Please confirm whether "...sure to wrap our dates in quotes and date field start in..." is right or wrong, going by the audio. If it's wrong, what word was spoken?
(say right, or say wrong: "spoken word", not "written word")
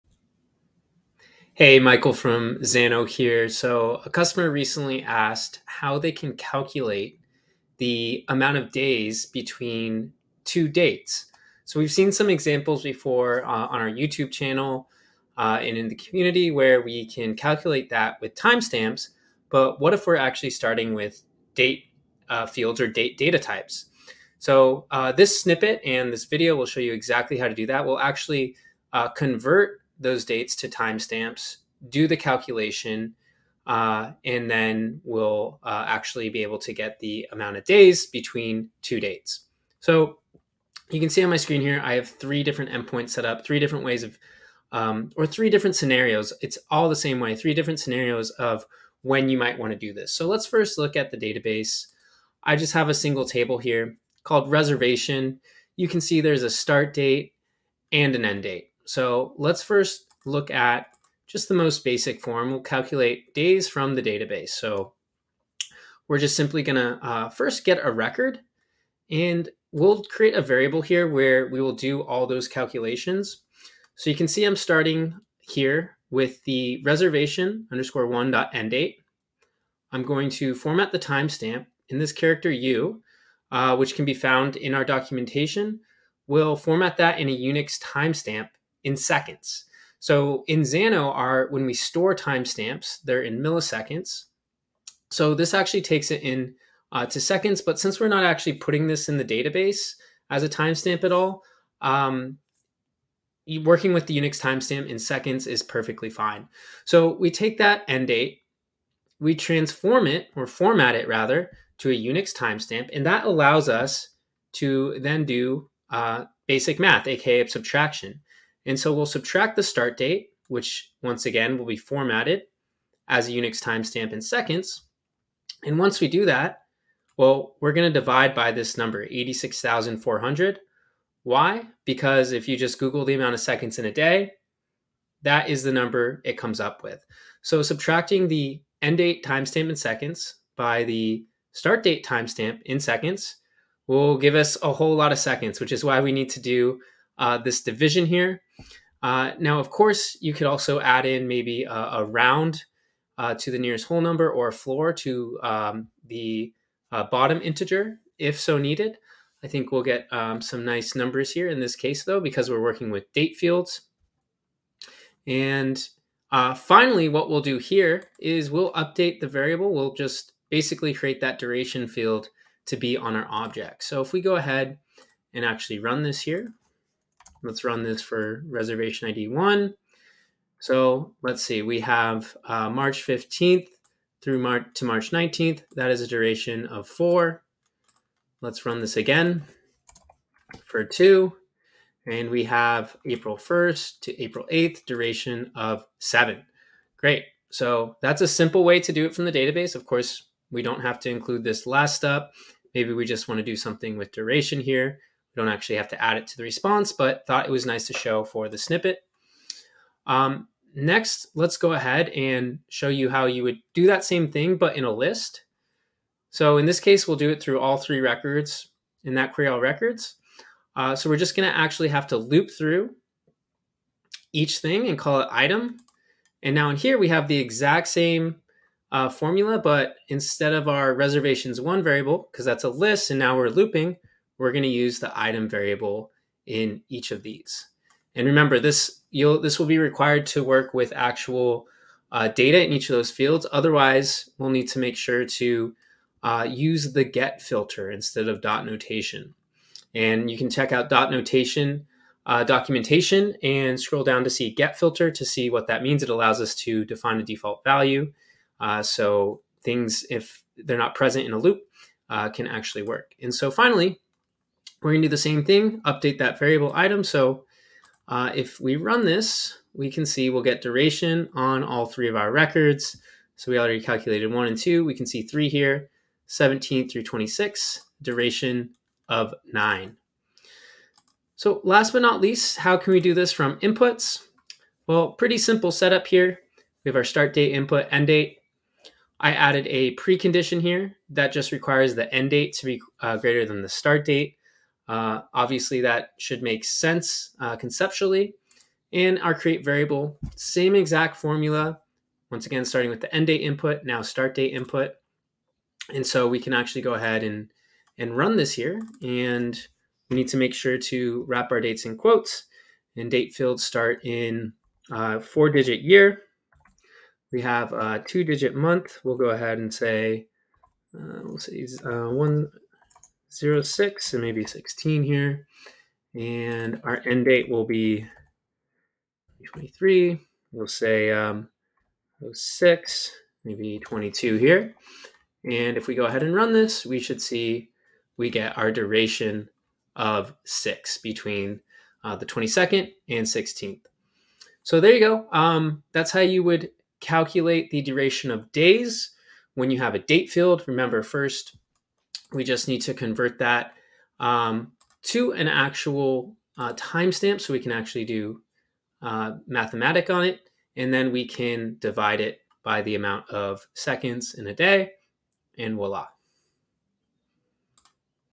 right.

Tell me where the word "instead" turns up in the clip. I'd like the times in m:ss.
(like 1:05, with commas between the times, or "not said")
3:50, 4:07.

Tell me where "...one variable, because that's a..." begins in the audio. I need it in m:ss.
3:51.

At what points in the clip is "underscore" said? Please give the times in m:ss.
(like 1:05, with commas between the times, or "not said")
1:17.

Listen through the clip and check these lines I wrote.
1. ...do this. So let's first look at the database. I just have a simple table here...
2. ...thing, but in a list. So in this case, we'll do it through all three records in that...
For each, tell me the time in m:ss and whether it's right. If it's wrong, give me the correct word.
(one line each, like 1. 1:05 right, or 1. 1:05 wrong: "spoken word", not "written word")
1. 0:49 wrong: "single", not "simple"
2. 3:34 right.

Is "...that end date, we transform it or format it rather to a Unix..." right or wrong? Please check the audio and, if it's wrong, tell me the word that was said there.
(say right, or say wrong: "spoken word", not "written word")
right.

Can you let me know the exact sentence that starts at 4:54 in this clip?
Uh, obviously, that should make sense uh, conceptually.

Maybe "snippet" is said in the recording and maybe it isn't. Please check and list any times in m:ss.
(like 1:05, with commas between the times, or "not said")
0:25, 3:28.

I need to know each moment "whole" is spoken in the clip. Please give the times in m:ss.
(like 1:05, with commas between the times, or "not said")
2:24, 2:33.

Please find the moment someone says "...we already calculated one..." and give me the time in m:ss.
4:33.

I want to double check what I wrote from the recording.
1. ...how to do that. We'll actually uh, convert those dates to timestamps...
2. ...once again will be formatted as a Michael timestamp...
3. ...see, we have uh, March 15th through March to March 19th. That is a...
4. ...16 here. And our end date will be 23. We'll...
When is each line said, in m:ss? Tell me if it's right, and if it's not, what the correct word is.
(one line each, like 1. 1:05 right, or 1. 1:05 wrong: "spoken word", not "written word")
1. 0:27 right
2. 2:01 wrong: "Unix", not "Michael"
3. 3:01 right
4. 5:24 right.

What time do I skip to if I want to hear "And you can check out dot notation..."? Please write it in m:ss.
4:09.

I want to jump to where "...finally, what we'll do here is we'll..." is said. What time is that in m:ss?
2:46.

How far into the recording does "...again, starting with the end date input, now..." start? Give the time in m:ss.
5:02.